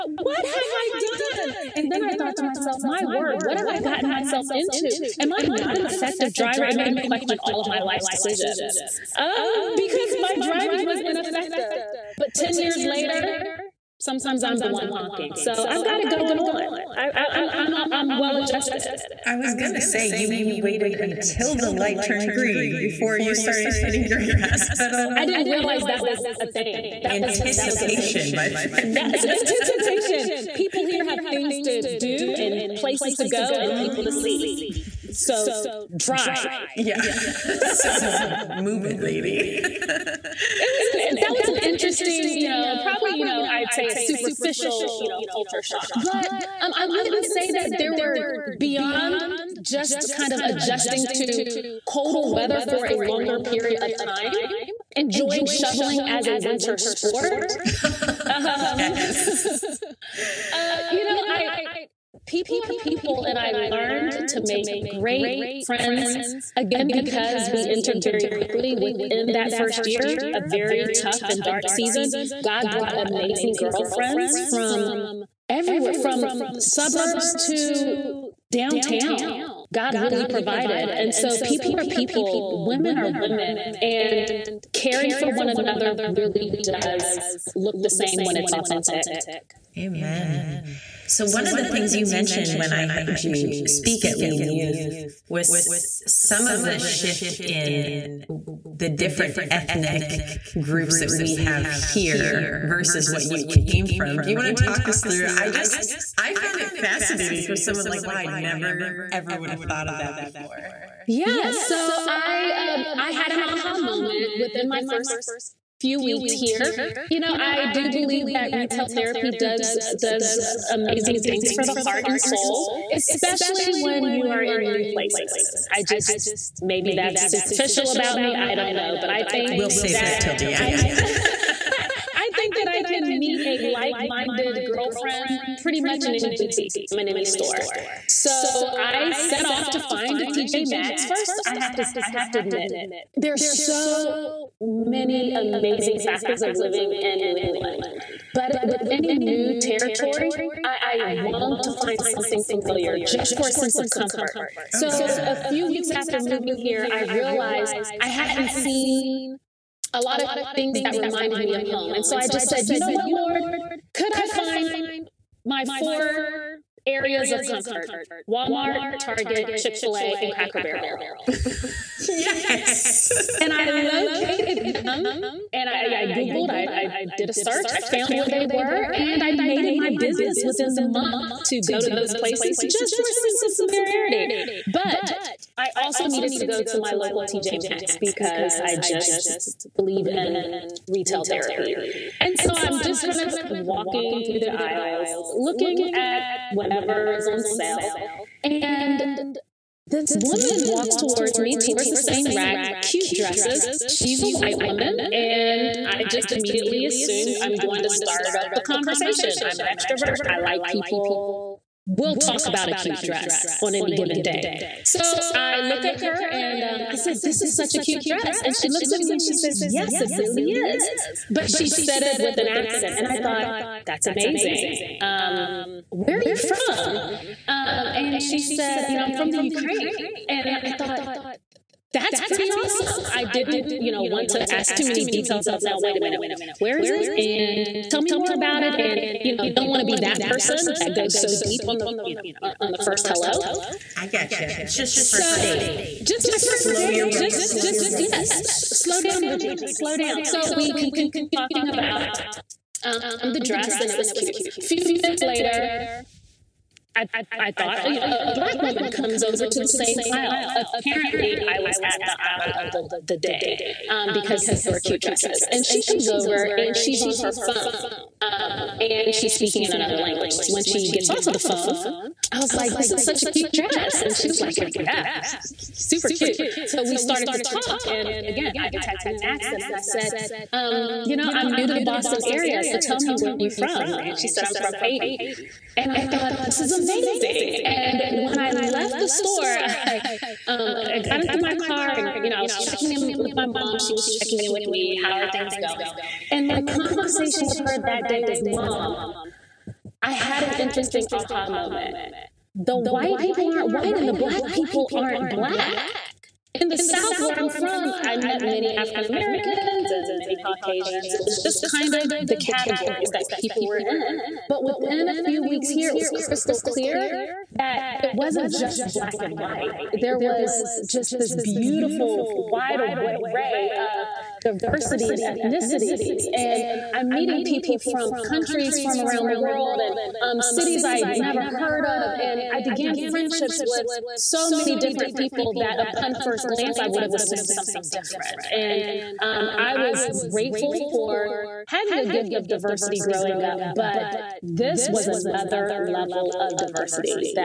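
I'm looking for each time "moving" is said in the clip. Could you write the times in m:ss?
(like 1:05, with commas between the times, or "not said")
2:36.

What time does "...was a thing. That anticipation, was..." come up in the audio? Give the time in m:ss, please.
0:26.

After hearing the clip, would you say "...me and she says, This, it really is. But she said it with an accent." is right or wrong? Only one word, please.
wrong.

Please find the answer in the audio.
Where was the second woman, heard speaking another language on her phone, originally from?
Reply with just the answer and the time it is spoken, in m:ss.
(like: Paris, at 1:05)
Haiti, at 4:44.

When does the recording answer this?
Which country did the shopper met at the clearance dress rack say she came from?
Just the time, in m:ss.
3:49.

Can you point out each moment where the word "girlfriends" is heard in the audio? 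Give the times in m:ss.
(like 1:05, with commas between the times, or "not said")
1:13, 2:14.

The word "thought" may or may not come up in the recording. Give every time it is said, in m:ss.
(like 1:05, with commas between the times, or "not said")
0:02, 1:49, 3:43, 3:50, 4:17, 4:46.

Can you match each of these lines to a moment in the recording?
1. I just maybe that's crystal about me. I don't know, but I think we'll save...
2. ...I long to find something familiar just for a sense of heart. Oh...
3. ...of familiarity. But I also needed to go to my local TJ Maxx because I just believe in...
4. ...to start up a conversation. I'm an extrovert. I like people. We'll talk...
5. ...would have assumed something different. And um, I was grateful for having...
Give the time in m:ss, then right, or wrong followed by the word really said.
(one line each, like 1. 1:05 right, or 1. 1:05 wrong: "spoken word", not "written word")
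1. 2:05 wrong: "superficial", not "crystal"
2. 2:30 wrong: "comfort", not "heart"
3. 3:03 right
4. 3:27 right
5. 5:36 right.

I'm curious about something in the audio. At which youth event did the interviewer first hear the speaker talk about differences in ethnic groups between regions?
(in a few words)
Lead Youth.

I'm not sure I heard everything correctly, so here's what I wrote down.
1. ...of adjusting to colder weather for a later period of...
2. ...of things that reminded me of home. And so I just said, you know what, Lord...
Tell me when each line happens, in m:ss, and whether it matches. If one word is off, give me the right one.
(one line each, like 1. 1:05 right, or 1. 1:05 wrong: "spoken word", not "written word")
1. 0:50 wrong: "longer", not "later"
2. 2:40 right.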